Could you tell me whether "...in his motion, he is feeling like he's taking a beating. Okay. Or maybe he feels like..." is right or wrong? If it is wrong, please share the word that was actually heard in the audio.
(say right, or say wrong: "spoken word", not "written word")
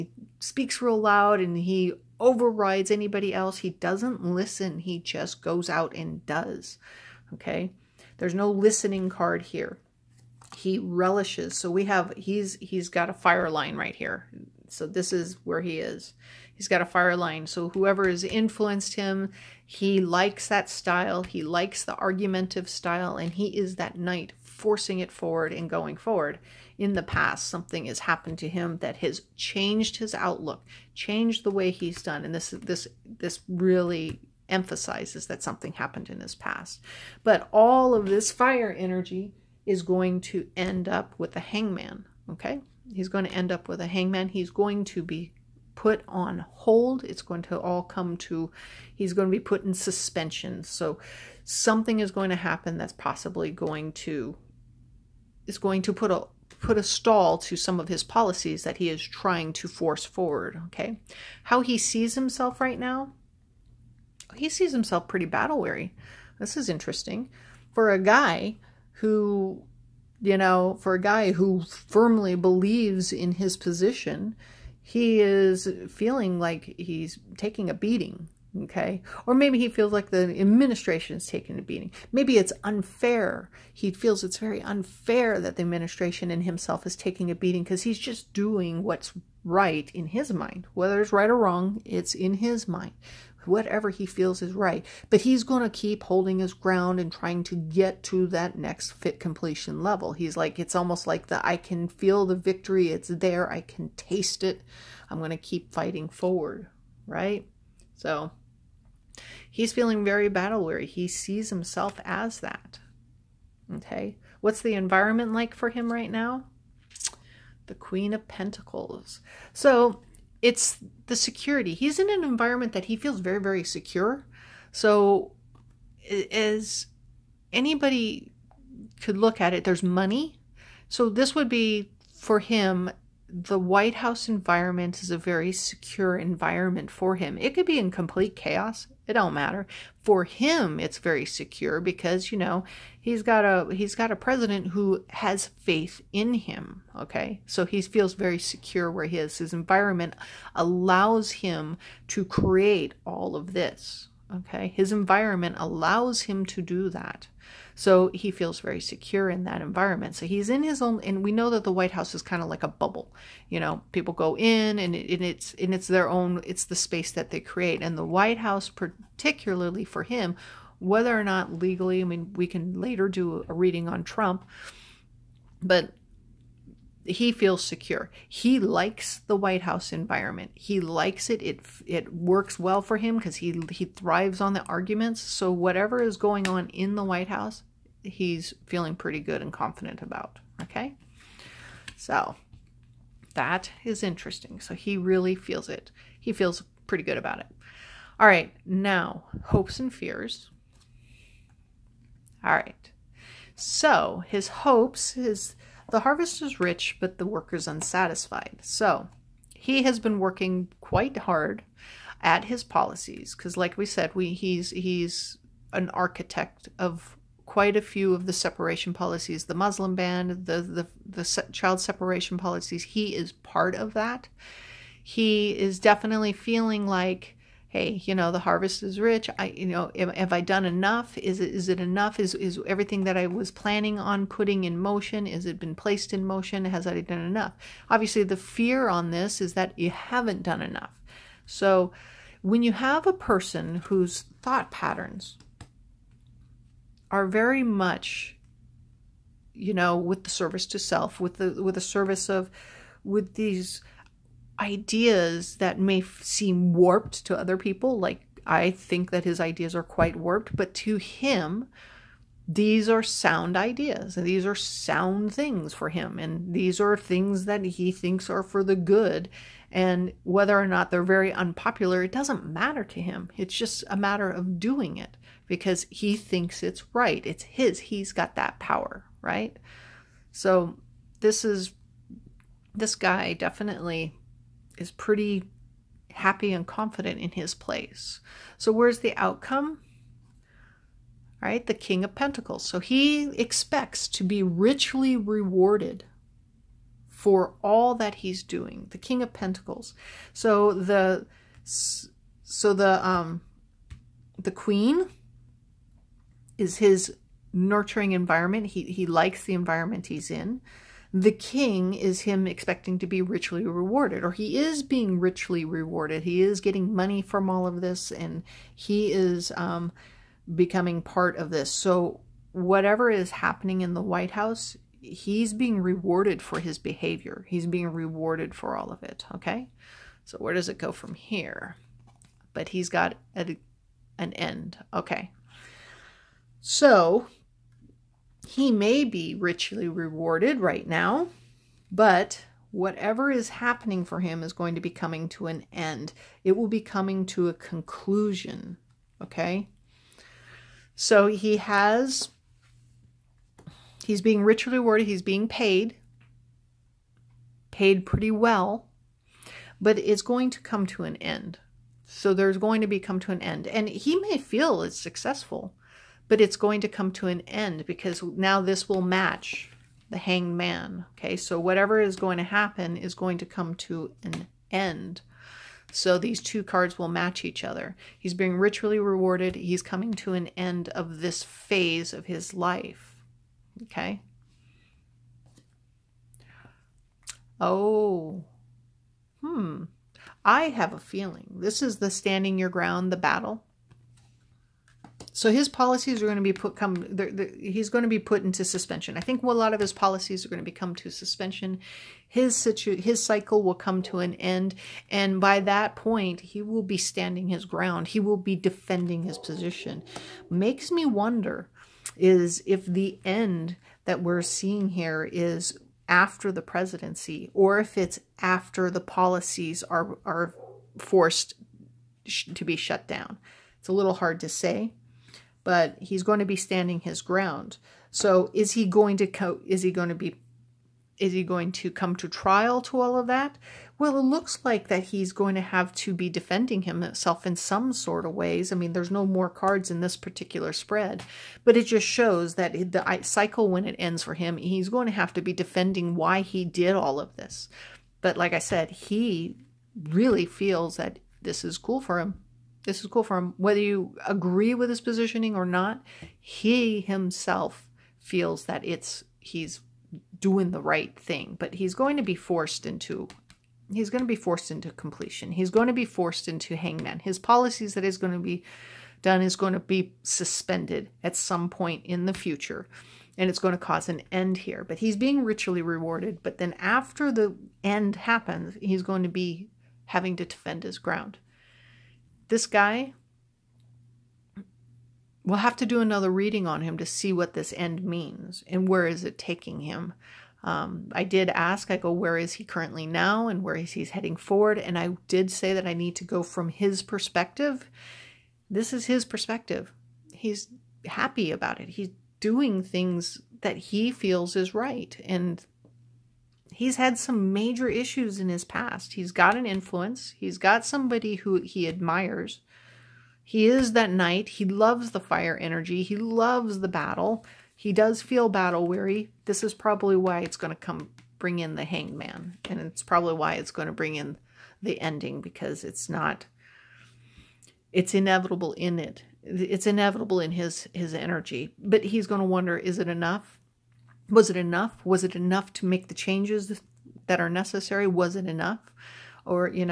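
wrong: "position", not "motion".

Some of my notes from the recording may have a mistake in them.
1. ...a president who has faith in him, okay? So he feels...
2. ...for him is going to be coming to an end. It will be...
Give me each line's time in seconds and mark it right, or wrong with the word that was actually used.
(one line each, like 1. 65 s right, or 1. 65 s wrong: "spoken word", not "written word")
1. 144 s right
2. 344 s right.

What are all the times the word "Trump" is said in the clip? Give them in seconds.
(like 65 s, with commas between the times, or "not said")
174 s.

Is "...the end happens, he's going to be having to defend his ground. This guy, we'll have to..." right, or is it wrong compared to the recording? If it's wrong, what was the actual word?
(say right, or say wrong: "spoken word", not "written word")
right.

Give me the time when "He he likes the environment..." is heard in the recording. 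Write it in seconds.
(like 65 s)
308 s.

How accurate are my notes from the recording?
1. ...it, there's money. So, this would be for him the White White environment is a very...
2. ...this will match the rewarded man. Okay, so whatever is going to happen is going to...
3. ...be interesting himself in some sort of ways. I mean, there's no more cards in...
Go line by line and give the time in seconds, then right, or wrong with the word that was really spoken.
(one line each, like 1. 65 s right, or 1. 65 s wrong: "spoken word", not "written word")
1. 129 s wrong: "House", not "White"
2. 368 s wrong: "hanged", not "rewarded"
3. 436 s wrong: "defending", not "interesting".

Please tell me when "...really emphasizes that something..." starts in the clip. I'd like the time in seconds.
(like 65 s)
33 s.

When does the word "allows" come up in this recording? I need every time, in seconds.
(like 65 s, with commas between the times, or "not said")
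150 s, 155 s.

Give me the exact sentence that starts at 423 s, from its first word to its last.
It's a little hard to say but he's going to be standing his ground.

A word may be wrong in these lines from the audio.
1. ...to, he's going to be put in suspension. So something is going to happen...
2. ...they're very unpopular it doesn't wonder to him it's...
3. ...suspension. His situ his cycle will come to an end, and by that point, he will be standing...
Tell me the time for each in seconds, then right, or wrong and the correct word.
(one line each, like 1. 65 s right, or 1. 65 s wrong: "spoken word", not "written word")
1. 48 s right
2. 270 s wrong: "matter", not "wonder"
3. 401 s right.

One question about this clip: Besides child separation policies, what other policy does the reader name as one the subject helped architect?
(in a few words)
Muslim ban.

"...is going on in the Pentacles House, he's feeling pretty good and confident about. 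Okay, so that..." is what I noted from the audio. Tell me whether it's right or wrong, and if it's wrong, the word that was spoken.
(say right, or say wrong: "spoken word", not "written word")
wrong: "White", not "Pentacles".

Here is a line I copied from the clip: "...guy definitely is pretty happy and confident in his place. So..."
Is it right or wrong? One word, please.
right.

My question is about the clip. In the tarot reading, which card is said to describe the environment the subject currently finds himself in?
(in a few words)
Queen of Pentacles.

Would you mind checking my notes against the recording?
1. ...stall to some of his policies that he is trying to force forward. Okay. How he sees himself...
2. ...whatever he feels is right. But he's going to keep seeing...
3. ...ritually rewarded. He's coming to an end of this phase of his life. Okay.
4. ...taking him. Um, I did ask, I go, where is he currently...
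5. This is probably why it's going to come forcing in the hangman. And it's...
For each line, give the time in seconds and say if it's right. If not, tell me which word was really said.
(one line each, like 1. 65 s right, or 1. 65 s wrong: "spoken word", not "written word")
1. 56 s right
2. 93 s wrong: "holding", not "seeing"
3. 378 s right
4. 489 s right
5. 519 s wrong: "bring", not "forcing".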